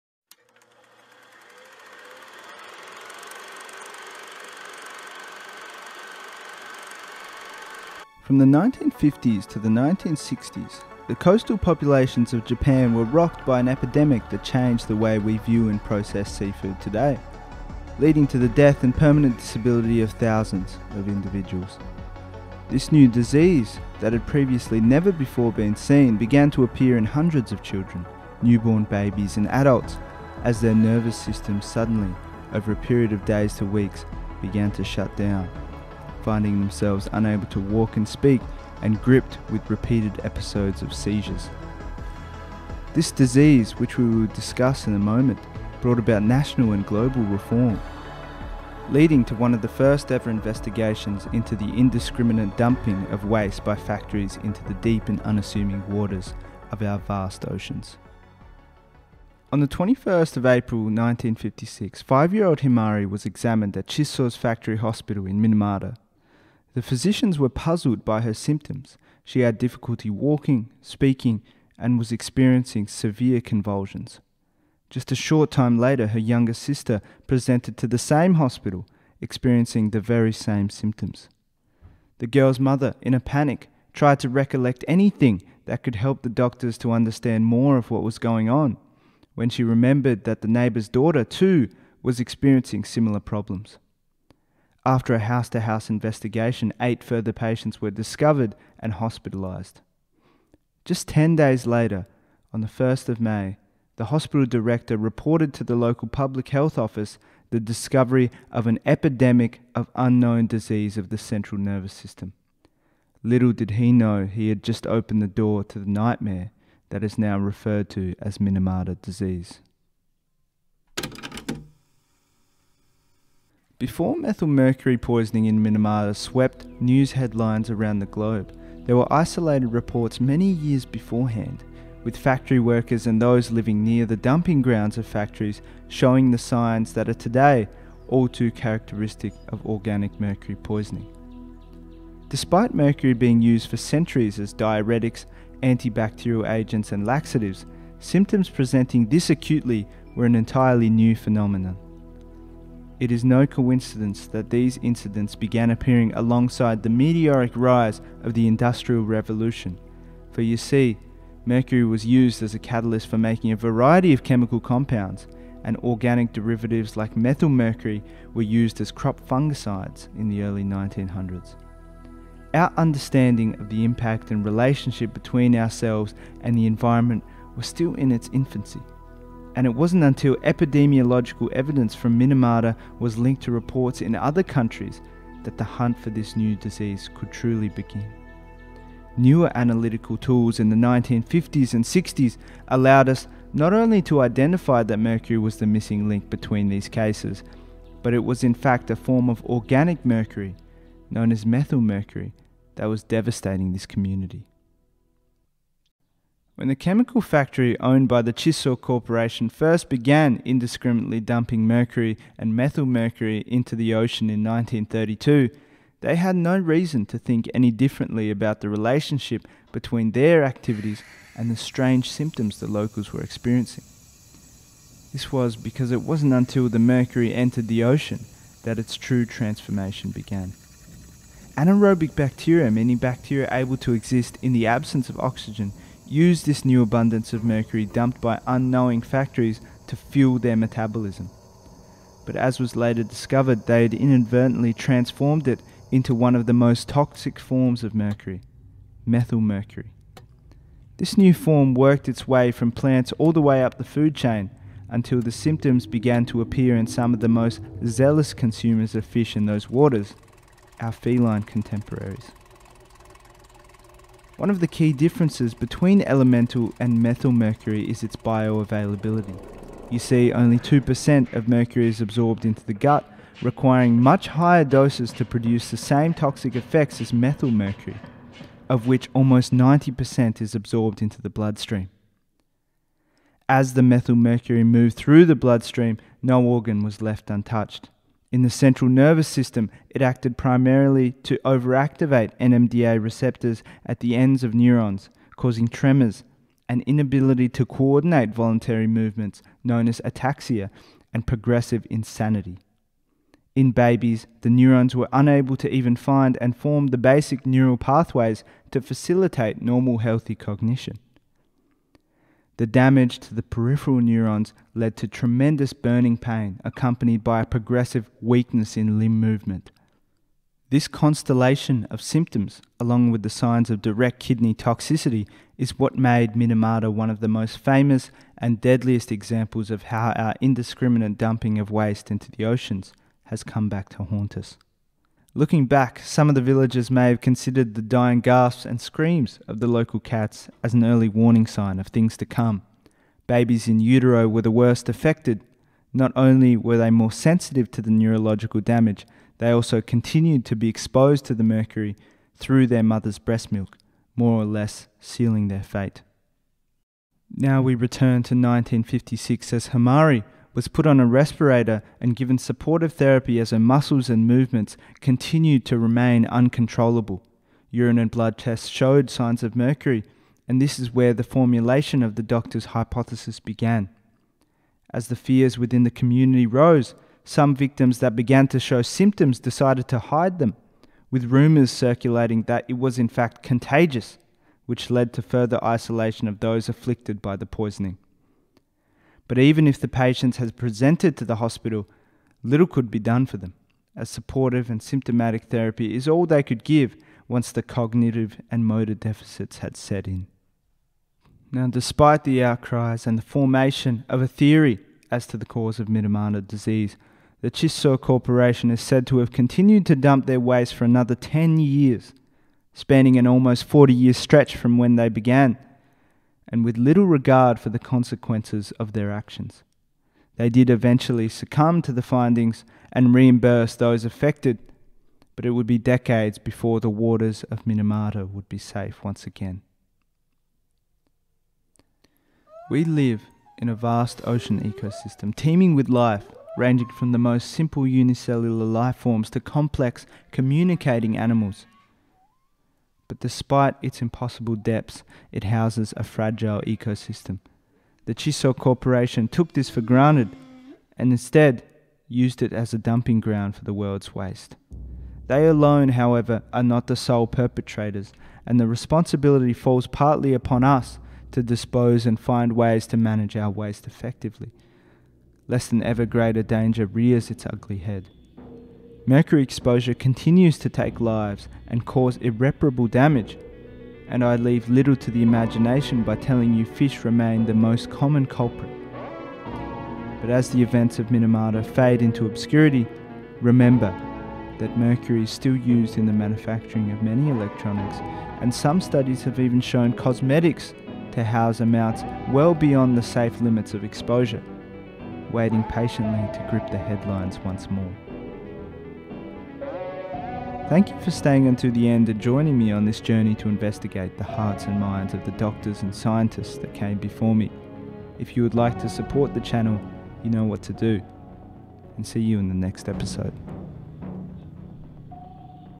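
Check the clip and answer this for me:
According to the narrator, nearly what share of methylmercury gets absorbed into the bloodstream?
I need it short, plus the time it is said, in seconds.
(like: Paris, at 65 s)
90%, at 279 s.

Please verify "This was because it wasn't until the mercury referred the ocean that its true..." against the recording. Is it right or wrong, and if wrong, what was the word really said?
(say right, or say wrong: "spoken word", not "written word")
wrong: "entered", not "referred".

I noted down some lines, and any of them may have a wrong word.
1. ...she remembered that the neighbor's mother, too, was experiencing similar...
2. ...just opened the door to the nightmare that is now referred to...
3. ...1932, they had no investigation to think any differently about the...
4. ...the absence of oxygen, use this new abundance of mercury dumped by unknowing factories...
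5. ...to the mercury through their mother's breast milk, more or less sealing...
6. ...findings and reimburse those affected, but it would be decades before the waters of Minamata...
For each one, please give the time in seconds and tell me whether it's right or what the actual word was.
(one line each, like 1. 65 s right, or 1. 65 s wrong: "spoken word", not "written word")
1. 89 s wrong: "daughter", not "mother"
2. 114 s right
3. 214 s wrong: "reason", not "investigation"
4. 234 s right
5. 351 s right
6. 422 s right.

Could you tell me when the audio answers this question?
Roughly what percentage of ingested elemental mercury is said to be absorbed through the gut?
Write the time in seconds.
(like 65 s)
270 s.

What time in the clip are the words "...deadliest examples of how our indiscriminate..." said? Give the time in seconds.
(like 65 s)
328 s.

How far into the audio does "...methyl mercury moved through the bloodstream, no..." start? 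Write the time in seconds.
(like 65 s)
283 s.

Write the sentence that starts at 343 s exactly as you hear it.
Babies in utero were the worst affected.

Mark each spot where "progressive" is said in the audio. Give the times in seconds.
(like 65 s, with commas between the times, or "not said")
301 s, 317 s.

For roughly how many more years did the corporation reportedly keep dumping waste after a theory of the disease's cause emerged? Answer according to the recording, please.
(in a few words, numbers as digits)
10 years.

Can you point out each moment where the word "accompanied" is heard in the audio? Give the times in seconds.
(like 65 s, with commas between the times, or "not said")
316 s.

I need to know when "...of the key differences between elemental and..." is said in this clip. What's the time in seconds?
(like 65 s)
264 s.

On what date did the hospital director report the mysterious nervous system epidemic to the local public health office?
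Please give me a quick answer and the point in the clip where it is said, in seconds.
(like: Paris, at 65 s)
1st of May, at 102 s.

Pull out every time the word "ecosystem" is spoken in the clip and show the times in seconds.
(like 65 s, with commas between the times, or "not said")
434 s, 446 s.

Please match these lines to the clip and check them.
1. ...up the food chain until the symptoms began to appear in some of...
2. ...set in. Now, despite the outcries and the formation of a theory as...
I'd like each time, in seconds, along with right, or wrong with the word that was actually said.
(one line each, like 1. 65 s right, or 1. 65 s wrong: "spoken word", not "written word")
1. 253 s right
2. 399 s right.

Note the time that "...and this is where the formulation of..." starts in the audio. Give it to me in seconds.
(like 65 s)
370 s.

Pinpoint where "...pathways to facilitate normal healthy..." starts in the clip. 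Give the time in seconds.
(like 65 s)
307 s.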